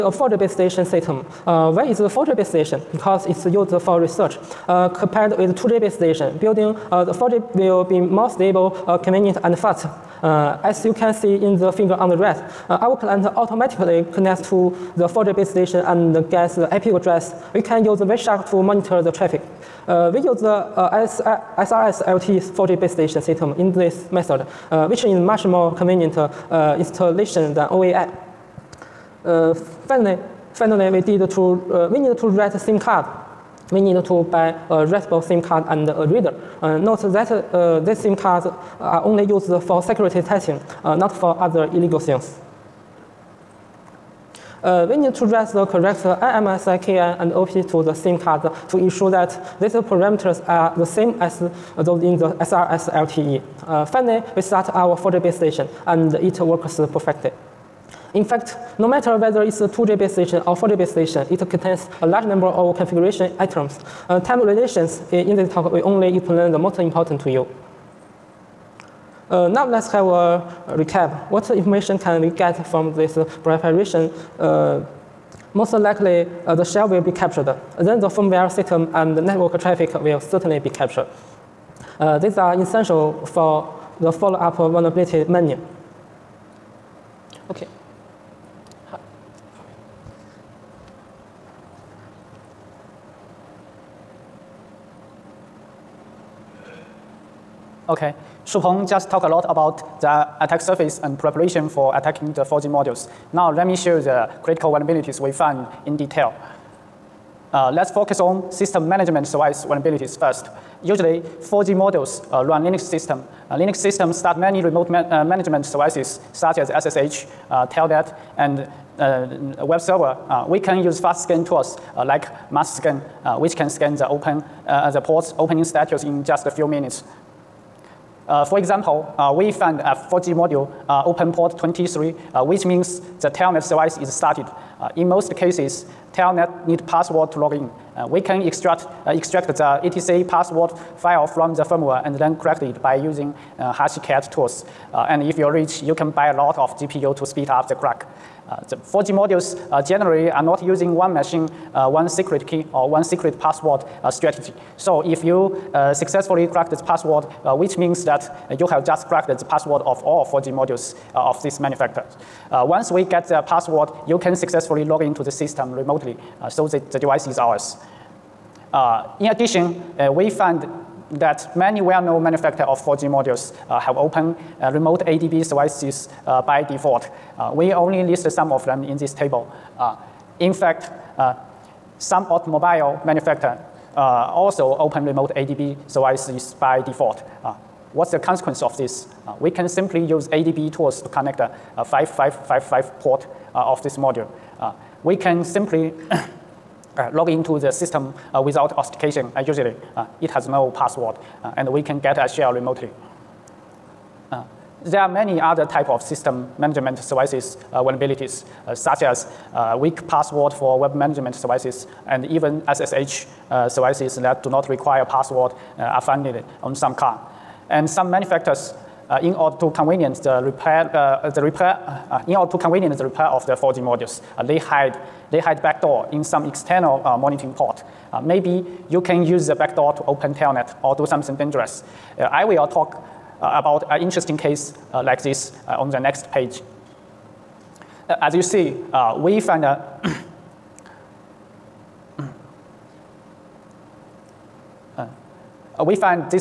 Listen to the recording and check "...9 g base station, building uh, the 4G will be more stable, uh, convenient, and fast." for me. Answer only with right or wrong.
wrong.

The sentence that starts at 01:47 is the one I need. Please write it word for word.
Uh, let's focus on system management device vulnerabilities first.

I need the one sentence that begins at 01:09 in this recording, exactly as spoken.
Uh, now let's have a recap.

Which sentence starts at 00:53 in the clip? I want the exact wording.
Uh, finally, we start our 4 g base station and it works perfectly.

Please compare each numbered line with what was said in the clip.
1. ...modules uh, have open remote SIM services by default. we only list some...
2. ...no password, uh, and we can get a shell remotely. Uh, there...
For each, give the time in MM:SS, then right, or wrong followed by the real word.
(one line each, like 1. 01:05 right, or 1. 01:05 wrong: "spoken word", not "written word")
1. 02:53 wrong: "ADB", not "SIM"
2. 03:20 right.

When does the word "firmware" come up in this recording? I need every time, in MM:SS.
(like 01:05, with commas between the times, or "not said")
01:18, 02:21.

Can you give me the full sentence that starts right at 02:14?
Uh, in most cases, telnet need password to log in.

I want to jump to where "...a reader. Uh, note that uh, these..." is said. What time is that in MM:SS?
00:35.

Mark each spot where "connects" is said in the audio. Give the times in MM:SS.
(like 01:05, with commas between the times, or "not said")
00:14, 03:11.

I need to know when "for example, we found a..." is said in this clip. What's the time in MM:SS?
02:08.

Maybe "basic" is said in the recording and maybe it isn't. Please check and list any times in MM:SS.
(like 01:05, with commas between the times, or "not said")
not said.